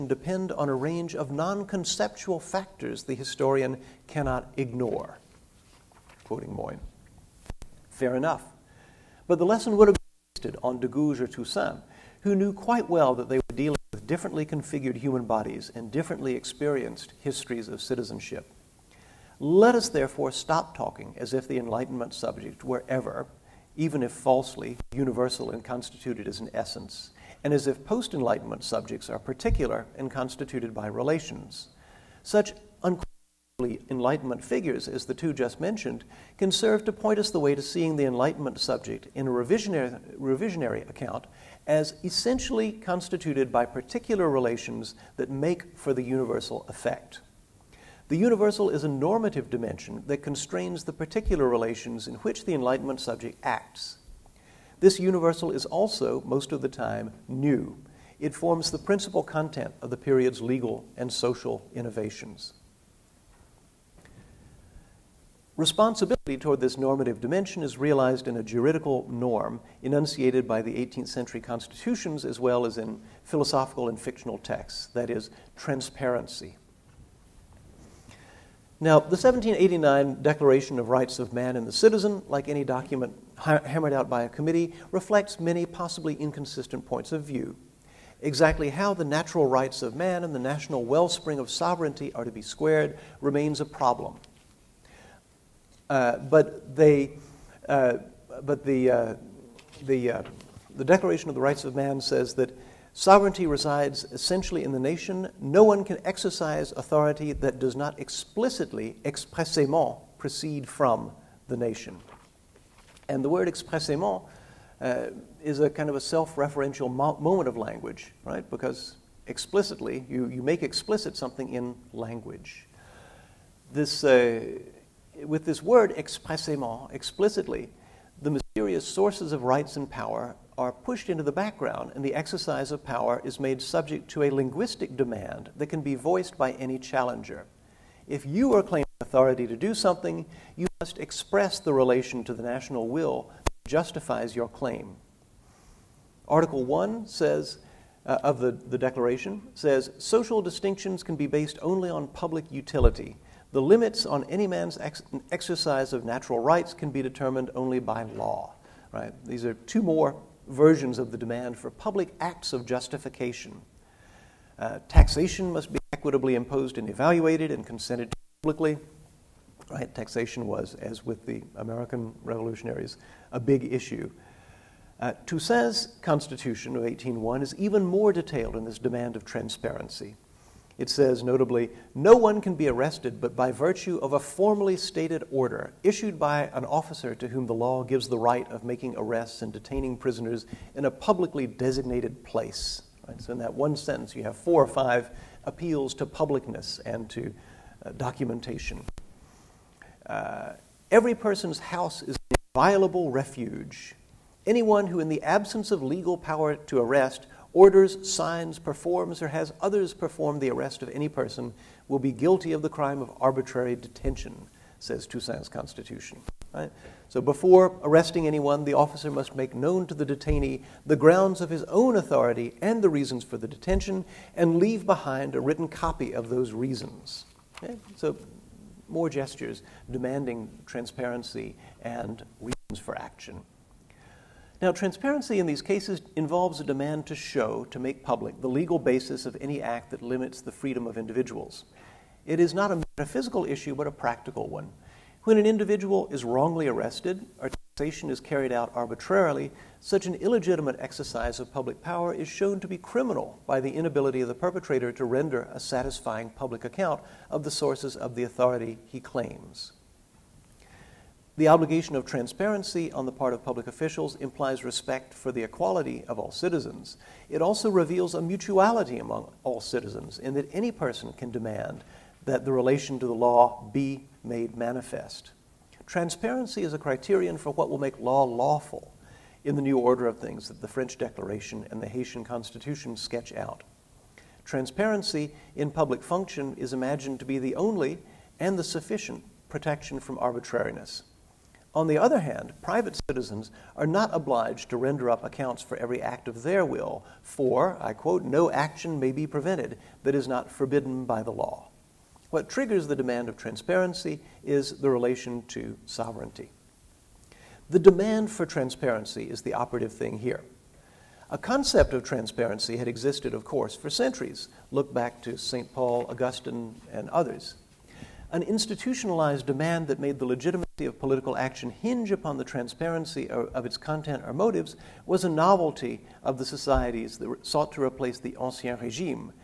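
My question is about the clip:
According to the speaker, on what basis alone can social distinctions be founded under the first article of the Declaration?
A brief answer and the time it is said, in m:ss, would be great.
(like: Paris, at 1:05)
public utility, at 2:32.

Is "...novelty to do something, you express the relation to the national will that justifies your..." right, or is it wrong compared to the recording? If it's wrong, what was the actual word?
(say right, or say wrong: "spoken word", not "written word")
wrong: "authority", not "novelty".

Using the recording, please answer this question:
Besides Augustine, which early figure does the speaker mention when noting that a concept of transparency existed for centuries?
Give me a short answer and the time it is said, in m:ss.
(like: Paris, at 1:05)
St. Paul, at 5:15.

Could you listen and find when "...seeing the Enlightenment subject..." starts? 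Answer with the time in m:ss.
0:37.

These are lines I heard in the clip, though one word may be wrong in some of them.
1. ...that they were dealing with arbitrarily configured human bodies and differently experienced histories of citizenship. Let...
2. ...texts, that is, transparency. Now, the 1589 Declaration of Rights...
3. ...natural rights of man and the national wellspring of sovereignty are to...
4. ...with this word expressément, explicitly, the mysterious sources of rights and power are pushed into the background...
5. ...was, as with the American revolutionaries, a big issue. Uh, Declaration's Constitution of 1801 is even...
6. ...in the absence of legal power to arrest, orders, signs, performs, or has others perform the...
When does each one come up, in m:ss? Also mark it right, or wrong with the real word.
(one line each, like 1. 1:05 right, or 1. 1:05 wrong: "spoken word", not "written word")
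1. 0:13 wrong: "differently", not "arbitrarily"
2. 1:14 wrong: "1789", not "1589"
3. 1:29 right
4. 2:05 right
5. 2:50 wrong: "Toussaint", not "Declaration"
6. 3:24 right.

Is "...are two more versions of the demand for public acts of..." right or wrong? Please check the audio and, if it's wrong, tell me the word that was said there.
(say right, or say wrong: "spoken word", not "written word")
right.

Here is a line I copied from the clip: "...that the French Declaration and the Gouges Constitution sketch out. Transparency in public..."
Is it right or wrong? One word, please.
wrong.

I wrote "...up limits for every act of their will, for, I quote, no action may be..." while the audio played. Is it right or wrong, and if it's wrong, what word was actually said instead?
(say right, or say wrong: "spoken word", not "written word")
wrong: "accounts", not "limits".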